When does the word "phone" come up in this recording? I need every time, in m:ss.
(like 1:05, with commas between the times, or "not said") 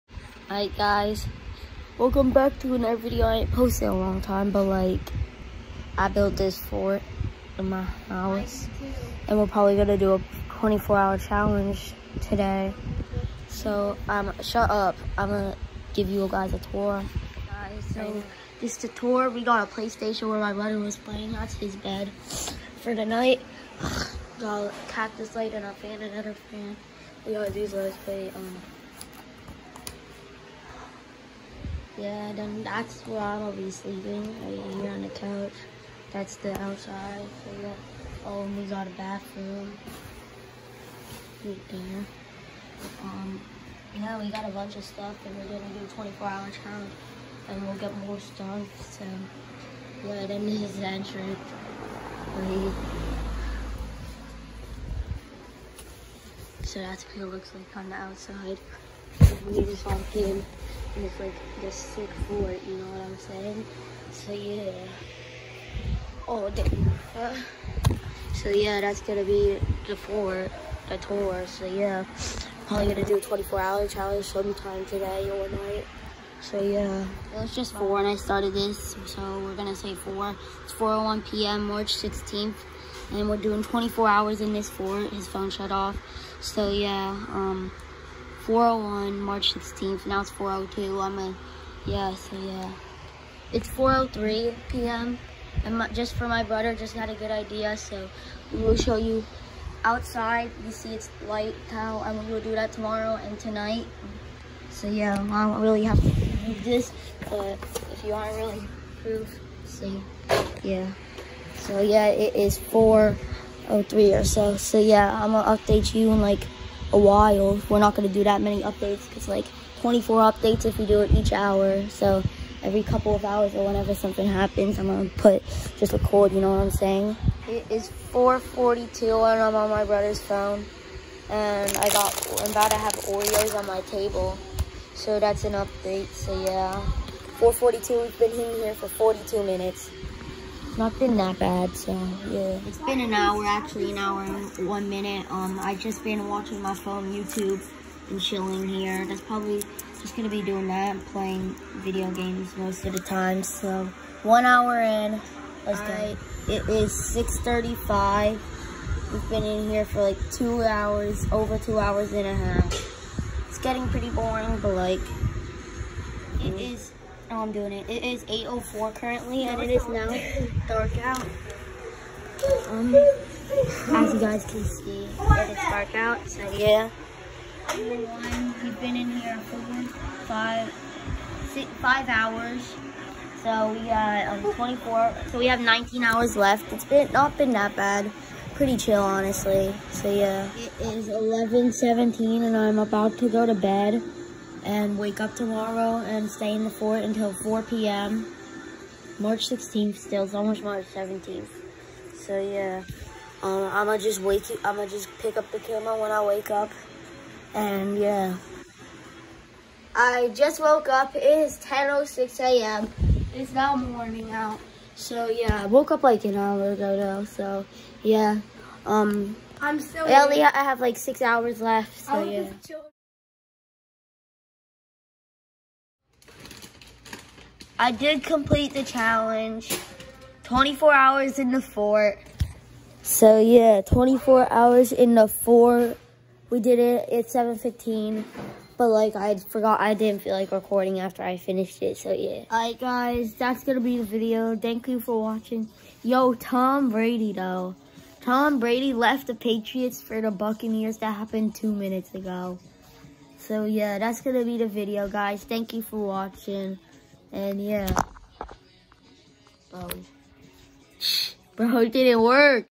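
1:25, 2:10, 2:26.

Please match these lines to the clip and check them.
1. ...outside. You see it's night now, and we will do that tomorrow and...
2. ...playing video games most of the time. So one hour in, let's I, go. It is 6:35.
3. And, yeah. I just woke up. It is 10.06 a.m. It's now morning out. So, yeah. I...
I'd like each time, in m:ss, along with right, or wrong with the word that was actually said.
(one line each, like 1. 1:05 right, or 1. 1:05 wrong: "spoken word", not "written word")
1. 1:39 wrong: "light", not "night"
2. 2:31 right
3. 3:27 right.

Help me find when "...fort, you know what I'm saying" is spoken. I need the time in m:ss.
1:02.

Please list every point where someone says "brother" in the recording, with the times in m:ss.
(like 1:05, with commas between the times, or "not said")
0:20, 1:36, 2:09.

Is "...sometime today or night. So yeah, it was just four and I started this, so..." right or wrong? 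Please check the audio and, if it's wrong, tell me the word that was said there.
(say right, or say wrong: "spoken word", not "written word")
right.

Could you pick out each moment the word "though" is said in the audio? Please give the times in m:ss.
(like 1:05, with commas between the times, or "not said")
3:36, 4:07.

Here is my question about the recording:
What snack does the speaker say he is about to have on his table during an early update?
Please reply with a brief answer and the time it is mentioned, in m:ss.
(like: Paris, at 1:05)
Oreos, at 2:13.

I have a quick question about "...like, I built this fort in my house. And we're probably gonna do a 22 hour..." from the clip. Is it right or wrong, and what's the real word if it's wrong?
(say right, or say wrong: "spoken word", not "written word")
wrong: "24", not "22".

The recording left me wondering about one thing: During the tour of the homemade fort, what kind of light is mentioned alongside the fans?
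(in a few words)
cactus light.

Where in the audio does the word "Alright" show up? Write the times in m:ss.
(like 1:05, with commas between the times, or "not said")
0:00, 4:02.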